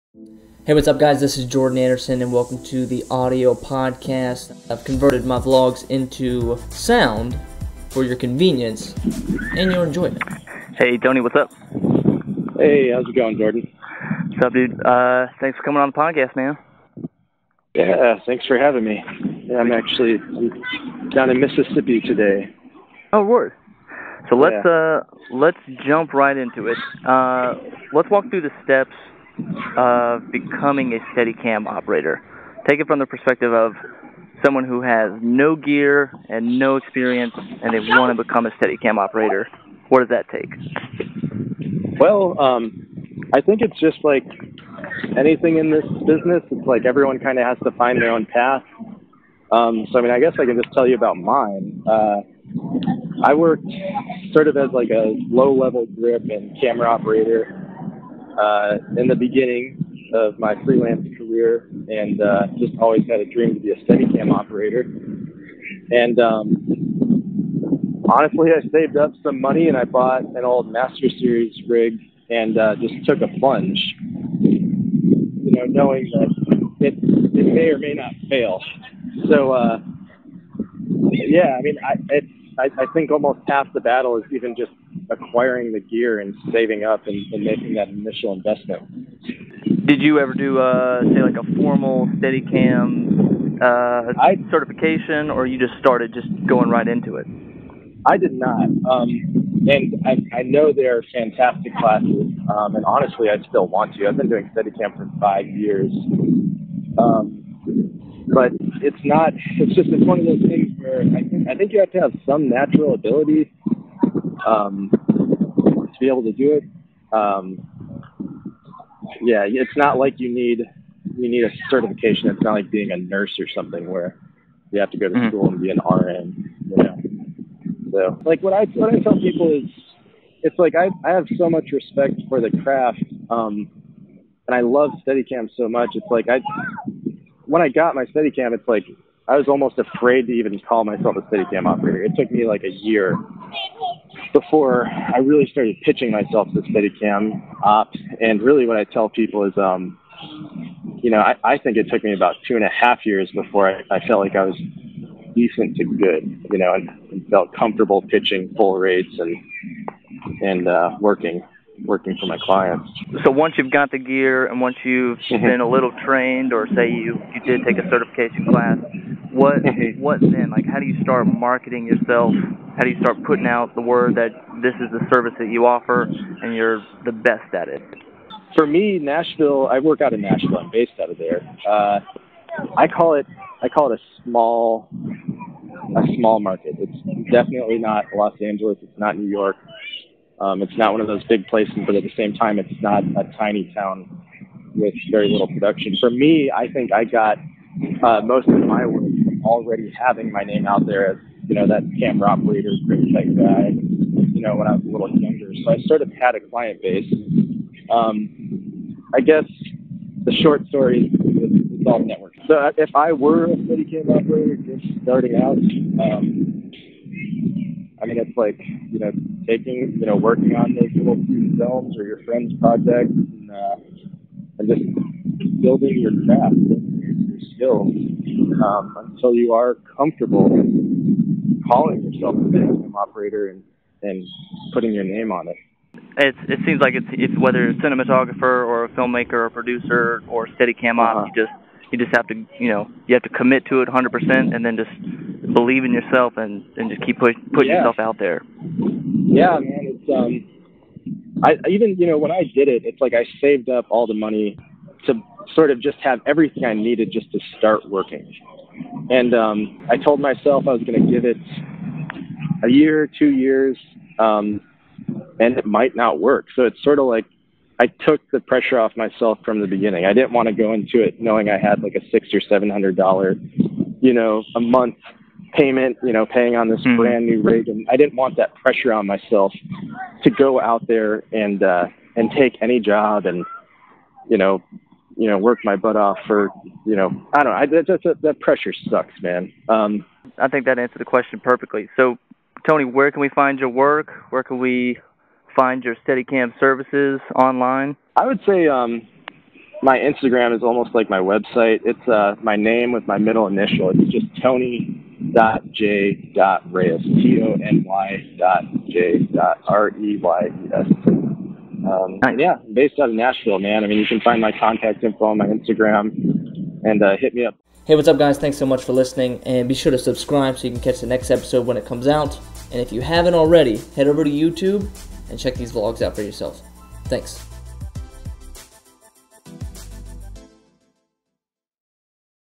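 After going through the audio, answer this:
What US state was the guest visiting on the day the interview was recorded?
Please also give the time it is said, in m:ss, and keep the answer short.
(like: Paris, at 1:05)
Mississippi, at 0:21.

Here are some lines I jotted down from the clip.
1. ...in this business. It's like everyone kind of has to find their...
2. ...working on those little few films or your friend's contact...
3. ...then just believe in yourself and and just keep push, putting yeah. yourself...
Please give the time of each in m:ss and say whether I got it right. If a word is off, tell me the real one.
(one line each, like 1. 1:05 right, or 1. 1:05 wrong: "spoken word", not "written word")
1. 0:45 right
2. 3:40 wrong: "project", not "contact"
3. 4:04 right.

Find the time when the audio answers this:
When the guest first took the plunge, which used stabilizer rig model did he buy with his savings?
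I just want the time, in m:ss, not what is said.
1:10.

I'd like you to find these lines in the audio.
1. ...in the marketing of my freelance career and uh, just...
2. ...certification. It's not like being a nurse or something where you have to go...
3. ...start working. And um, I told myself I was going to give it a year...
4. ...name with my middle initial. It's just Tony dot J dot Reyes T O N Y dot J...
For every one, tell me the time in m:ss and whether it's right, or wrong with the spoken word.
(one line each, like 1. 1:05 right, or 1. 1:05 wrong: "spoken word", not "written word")
1. 0:58 wrong: "beginning", not "marketing"
2. 2:01 right
3. 4:17 right
4. 5:02 right.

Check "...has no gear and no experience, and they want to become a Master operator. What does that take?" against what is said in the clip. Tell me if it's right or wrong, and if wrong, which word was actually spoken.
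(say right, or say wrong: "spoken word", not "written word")
wrong: "Steadicam", not "Master".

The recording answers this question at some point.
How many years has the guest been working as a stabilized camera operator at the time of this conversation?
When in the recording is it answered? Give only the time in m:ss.
1:45.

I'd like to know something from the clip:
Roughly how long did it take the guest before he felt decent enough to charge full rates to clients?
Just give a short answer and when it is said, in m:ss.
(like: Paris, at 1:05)
2.5 years, at 2:32.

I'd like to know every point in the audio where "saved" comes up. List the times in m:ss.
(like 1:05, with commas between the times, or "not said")
1:08, 4:13.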